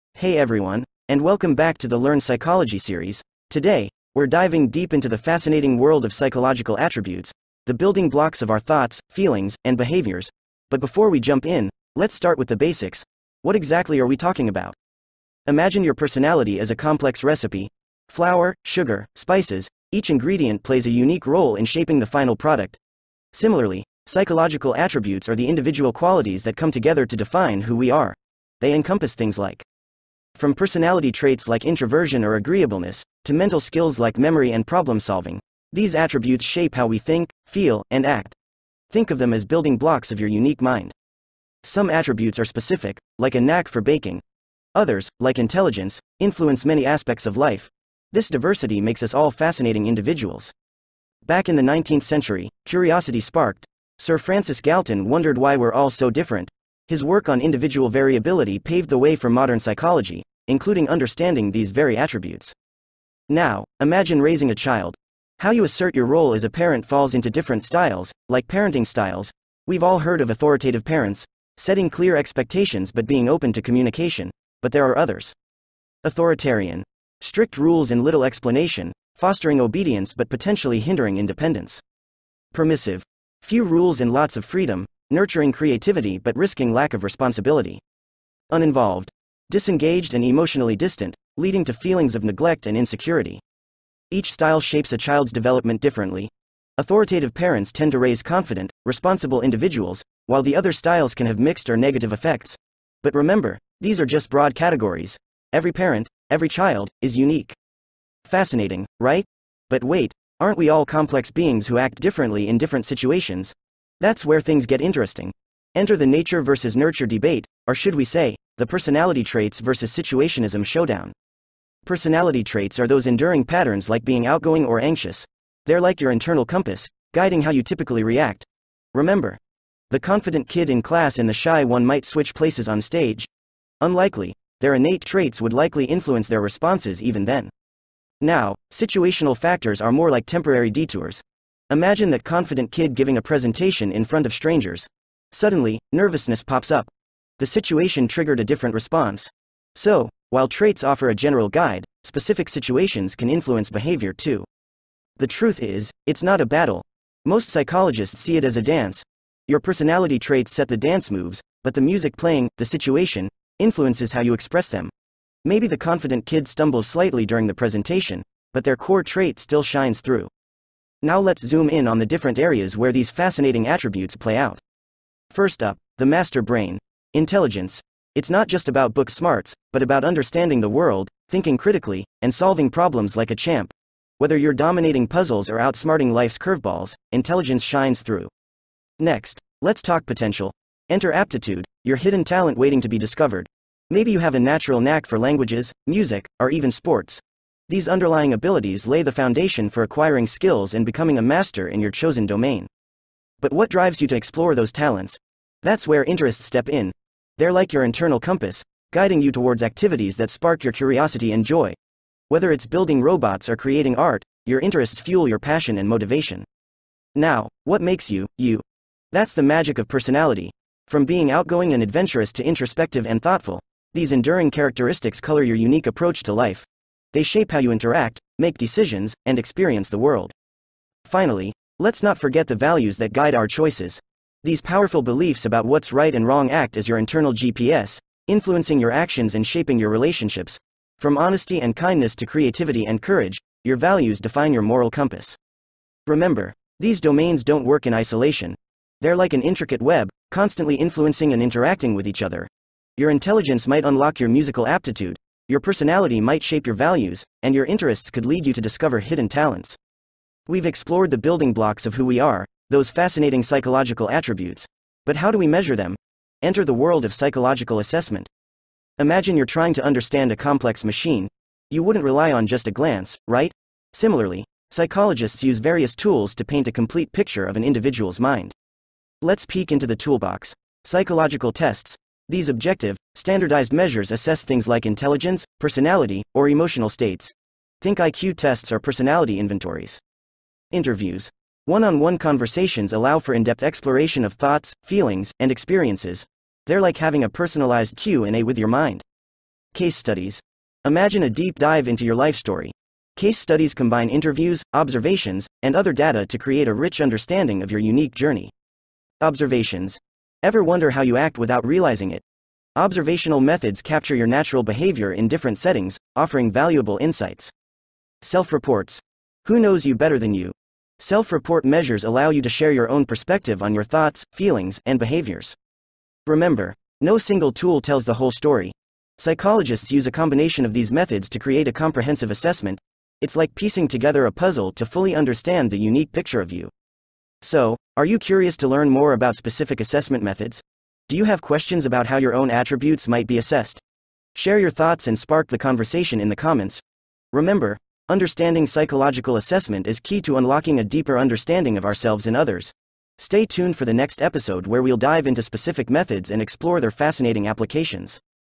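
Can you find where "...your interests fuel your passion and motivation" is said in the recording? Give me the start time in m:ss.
3:34.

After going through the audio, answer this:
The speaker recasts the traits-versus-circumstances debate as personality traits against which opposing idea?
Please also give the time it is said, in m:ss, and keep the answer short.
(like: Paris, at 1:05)
situationism, at 1:59.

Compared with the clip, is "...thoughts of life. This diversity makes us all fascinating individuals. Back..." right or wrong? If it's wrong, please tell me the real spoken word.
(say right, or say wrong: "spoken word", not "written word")
wrong: "aspects", not "thoughts".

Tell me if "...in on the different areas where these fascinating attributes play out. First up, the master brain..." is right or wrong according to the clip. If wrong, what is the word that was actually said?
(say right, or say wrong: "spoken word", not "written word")
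right.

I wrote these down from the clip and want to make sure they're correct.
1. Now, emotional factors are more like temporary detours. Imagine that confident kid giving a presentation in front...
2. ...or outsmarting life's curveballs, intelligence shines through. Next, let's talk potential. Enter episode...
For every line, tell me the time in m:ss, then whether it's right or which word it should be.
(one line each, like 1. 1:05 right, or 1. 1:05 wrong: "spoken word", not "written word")
1. 2:18 wrong: "situational", not "emotional"
2. 3:05 wrong: "aptitude", not "episode".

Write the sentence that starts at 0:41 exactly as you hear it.
Some attributes are specific, like a knack for baking.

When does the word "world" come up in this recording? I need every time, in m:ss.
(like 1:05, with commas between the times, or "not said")
0:05, 3:00, 3:49, 4:26.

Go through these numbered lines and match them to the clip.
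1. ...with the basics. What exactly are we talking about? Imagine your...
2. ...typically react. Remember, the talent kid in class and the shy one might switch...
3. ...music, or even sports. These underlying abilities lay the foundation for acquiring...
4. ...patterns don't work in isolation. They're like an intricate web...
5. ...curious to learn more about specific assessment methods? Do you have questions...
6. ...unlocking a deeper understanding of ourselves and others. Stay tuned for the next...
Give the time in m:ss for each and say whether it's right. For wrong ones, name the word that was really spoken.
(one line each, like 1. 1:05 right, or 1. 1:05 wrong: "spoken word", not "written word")
1. 0:12 right
2. 2:07 wrong: "confident", not "talent"
3. 3:15 right
4. 4:06 wrong: "domains", not "patterns"
5. 5:38 right
6. 5:50 right.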